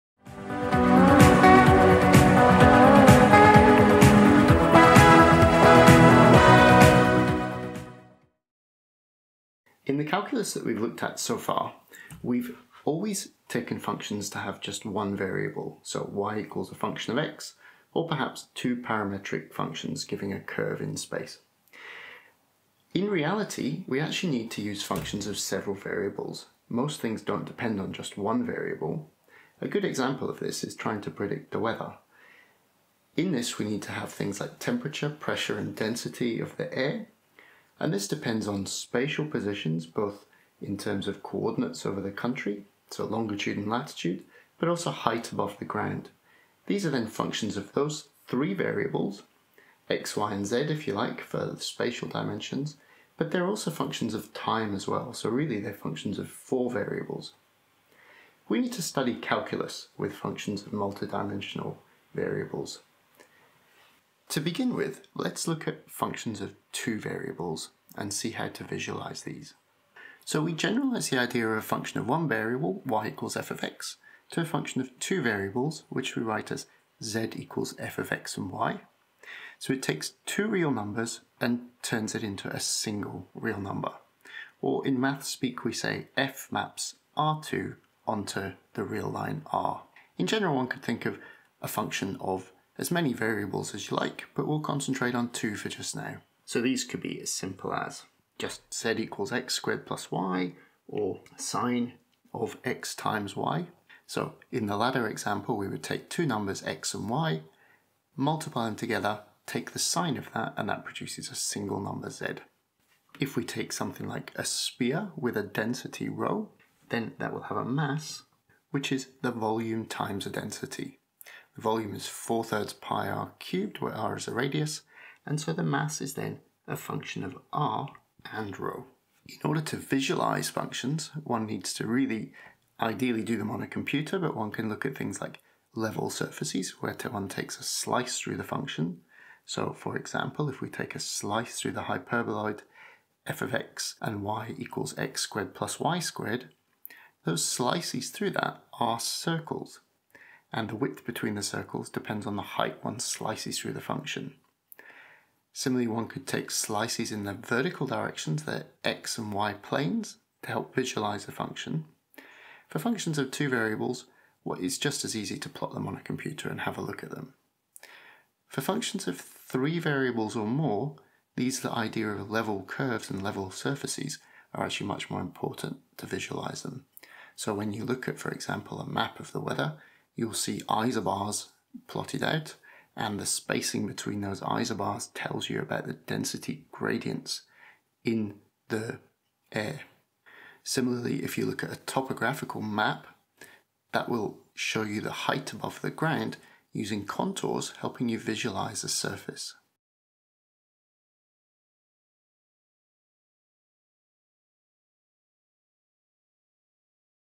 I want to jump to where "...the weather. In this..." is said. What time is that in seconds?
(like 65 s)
31 s.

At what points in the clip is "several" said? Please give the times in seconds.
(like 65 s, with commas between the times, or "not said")
25 s.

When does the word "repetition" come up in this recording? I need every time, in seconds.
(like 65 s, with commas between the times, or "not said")
not said.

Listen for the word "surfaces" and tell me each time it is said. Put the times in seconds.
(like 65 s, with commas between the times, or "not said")
136 s, 173 s, 198 s.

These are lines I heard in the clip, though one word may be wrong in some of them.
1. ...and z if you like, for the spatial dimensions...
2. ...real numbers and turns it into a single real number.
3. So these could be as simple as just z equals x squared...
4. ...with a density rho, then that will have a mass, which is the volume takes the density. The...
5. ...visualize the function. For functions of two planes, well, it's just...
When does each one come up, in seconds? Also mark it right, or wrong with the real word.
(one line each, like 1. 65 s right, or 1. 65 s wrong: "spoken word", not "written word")
1. 50 s right
2. 80 s right
3. 96 s right
4. 115 s wrong: "times", not "takes"
5. 160 s wrong: "variables", not "planes".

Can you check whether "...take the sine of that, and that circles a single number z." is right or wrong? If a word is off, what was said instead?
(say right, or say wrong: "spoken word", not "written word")
wrong: "produces", not "circles".